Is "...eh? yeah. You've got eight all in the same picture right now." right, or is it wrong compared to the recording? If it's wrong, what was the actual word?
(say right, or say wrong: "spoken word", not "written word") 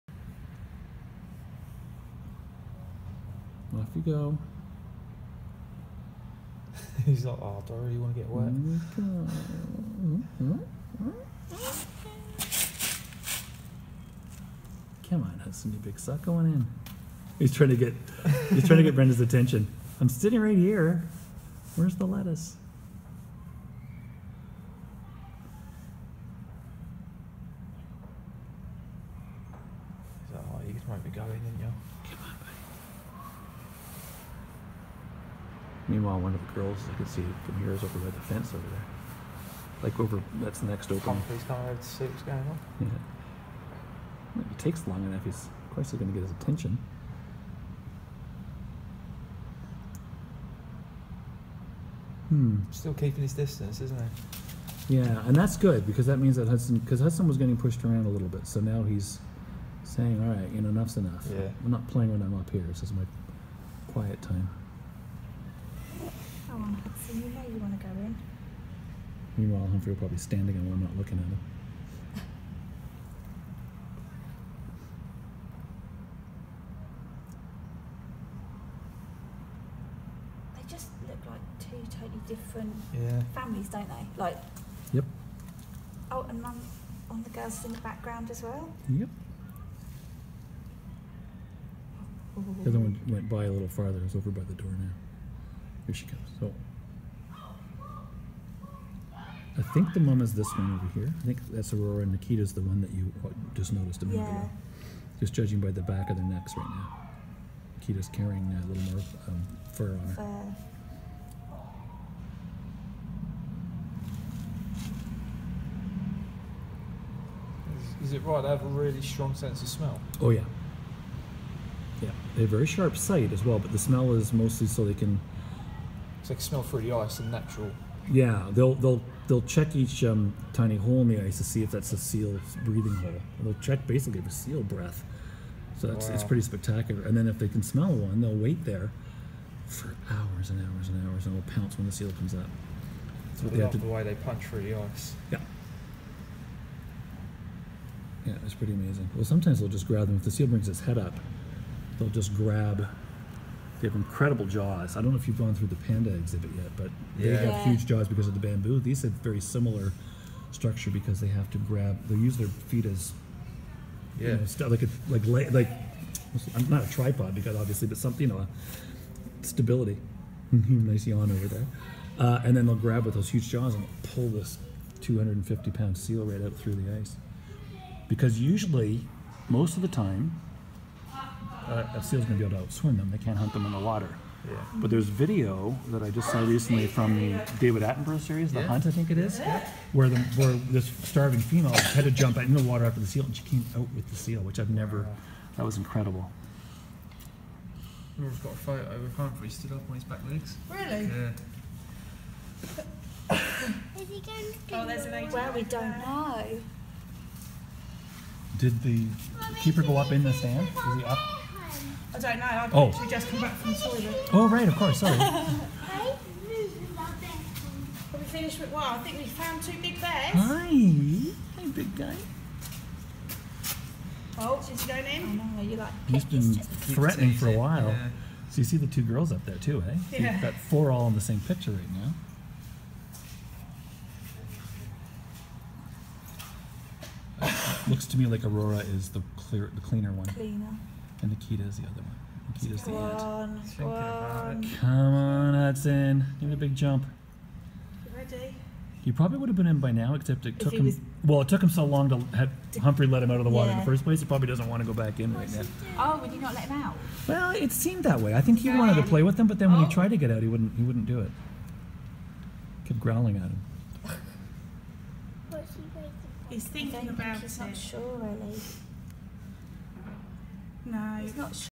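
wrong: "four", not "eight".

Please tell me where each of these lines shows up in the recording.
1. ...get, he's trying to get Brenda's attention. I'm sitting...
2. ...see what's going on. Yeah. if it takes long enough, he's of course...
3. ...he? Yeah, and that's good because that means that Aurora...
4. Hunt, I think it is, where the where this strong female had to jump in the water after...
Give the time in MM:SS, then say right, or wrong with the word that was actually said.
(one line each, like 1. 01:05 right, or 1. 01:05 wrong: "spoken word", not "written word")
1. 00:17 right
2. 00:41 right
3. 00:53 wrong: "Hudson", not "Aurora"
4. 03:08 wrong: "starving", not "strong".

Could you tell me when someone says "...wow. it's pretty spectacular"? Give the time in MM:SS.
02:15.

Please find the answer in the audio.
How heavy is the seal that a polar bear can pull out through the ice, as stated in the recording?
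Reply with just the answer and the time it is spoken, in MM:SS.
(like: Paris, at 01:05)
250 pounds, at 02:55.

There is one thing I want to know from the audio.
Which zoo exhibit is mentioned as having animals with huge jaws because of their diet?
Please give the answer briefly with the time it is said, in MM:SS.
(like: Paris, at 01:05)
The panda exhibit, at 02:35.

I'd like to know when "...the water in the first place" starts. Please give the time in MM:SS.
04:13.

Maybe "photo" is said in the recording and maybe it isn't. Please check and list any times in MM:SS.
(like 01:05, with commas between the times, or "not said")
03:18.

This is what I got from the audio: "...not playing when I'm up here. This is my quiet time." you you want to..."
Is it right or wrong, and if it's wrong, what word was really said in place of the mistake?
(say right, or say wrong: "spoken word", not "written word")
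right.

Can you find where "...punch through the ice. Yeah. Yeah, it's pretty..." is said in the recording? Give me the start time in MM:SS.
02:24.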